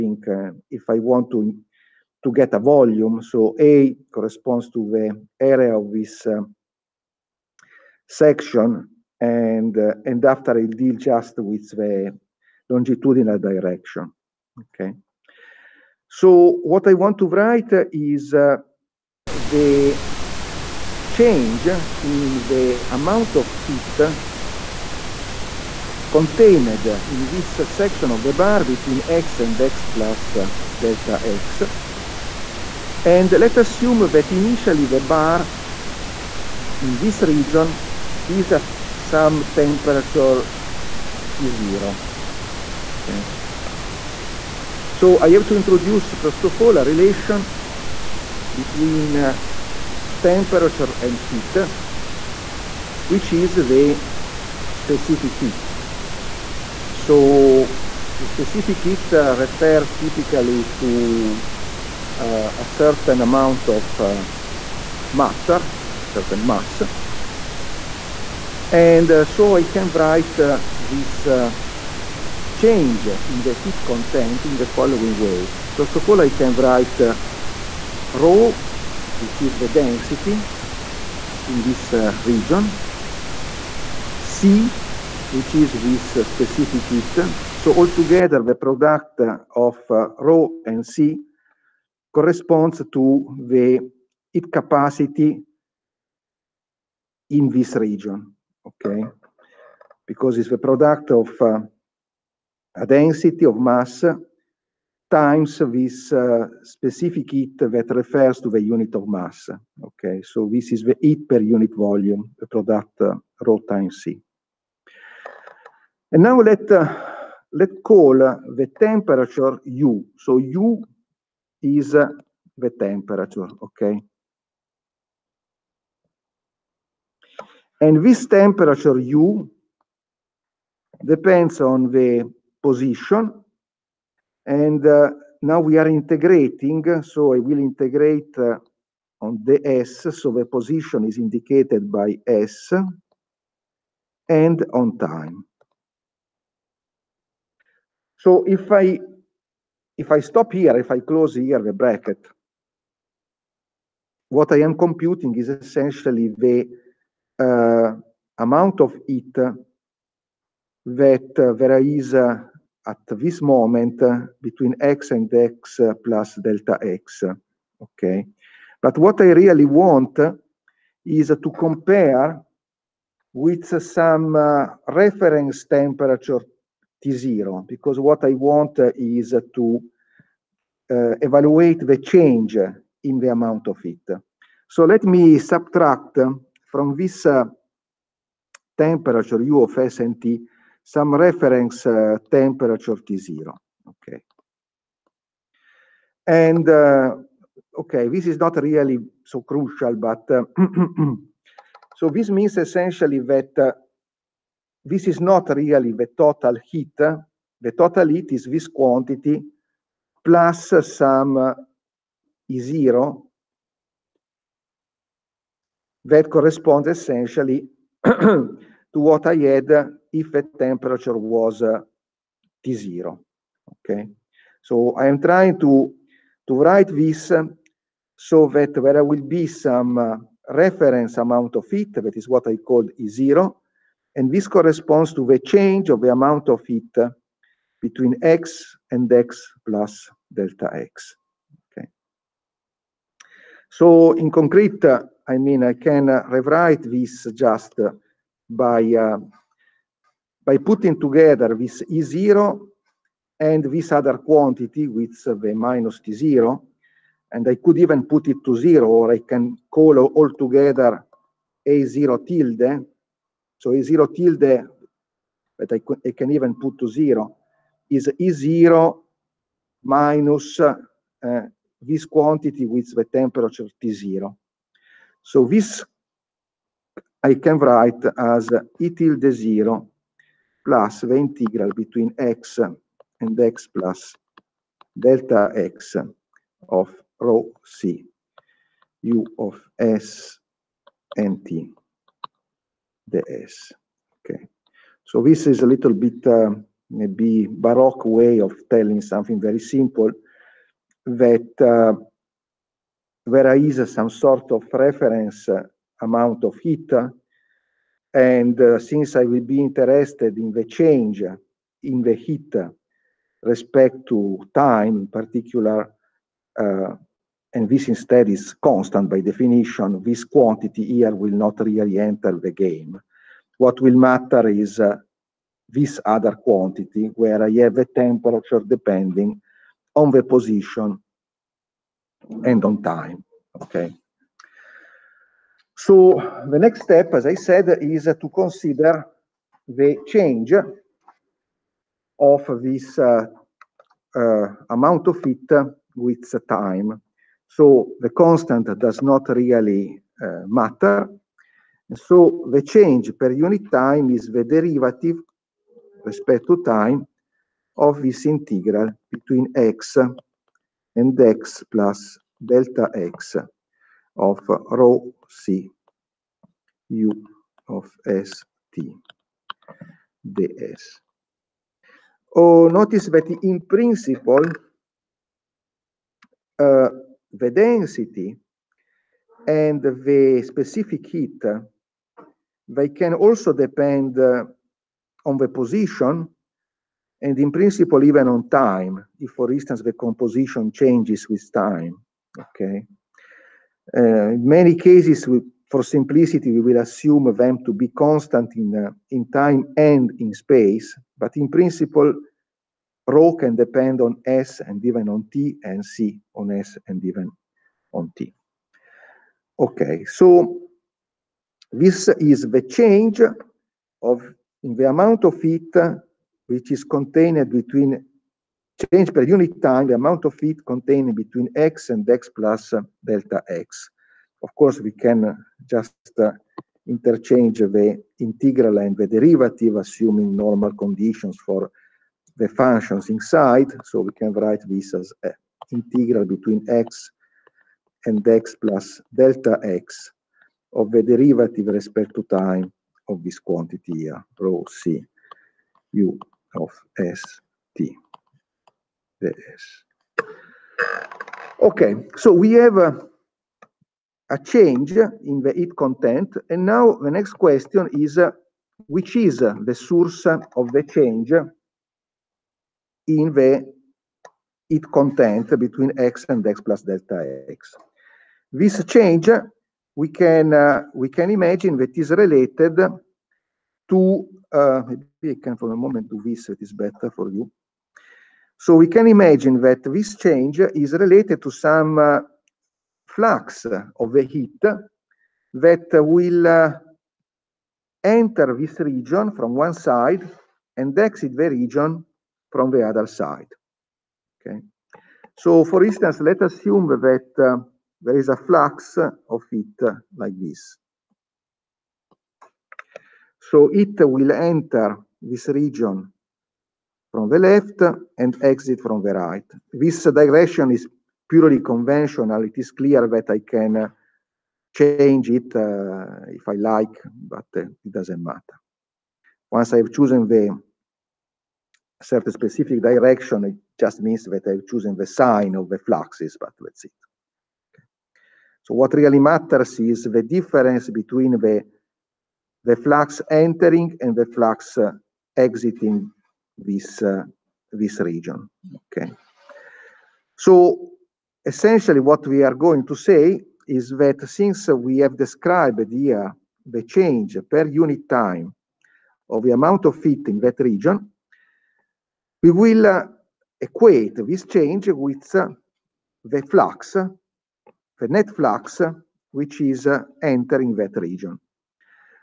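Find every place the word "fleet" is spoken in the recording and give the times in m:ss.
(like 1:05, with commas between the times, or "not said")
not said.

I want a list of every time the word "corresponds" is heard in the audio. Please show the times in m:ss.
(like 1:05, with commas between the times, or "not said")
0:04, 1:32, 3:36, 3:54.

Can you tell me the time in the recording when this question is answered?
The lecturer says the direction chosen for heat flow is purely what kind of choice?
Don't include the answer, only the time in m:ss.
8:31.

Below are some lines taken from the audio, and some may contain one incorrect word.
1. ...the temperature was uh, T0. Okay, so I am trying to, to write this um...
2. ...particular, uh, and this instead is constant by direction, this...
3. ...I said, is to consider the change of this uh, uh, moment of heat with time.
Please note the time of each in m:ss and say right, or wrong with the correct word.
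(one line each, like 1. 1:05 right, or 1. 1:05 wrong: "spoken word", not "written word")
1. 3:40 right
2. 5:15 wrong: "definition", not "direction"
3. 5:37 wrong: "amount", not "moment".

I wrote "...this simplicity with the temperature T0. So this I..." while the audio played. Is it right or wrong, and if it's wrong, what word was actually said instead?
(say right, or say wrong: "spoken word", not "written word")
wrong: "quantity", not "simplicity".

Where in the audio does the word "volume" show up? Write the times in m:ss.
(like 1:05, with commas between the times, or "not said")
0:02, 1:51.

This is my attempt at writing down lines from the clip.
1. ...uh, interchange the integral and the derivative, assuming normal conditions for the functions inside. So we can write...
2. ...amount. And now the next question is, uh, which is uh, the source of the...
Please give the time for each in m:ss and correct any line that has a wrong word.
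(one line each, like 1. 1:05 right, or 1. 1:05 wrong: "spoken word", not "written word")
1. 7:06 right
2. 7:35 wrong: "content", not "amount".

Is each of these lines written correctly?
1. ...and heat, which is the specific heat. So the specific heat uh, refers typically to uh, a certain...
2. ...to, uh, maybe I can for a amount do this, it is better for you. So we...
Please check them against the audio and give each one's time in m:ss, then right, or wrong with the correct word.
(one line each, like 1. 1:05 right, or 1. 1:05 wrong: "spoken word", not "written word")
1. 0:50 right
2. 7:53 wrong: "moment", not "amount".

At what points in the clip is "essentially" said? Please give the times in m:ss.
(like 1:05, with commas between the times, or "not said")
2:35, 3:22, 3:36, 9:01.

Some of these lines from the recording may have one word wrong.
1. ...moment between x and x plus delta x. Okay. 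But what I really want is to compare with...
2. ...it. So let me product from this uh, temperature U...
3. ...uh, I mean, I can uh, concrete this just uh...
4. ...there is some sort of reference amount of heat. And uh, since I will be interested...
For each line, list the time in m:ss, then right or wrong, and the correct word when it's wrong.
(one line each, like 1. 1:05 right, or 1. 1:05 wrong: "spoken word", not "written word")
1. 2:43 right
2. 3:03 wrong: "subtract", not "product"
3. 4:04 wrong: "rewrite", not "concrete"
4. 5:03 right.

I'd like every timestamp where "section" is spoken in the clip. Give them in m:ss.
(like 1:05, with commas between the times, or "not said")
0:08, 0:27.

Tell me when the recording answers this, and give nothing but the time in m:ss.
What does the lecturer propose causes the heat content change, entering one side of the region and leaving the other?
8:03.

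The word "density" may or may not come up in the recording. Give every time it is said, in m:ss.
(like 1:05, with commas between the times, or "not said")
1:19, 1:42, 6:17.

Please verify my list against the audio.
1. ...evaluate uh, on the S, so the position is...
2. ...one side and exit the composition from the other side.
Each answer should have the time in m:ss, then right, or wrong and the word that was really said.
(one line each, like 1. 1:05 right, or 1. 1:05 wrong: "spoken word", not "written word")
1. 2:17 wrong: "integrate", not "evaluate"
2. 8:09 wrong: "region", not "composition".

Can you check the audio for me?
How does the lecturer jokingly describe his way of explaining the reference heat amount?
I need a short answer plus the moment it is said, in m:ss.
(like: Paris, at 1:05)
baroque, at 4:57.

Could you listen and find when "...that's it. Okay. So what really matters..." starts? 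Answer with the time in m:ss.
8:46.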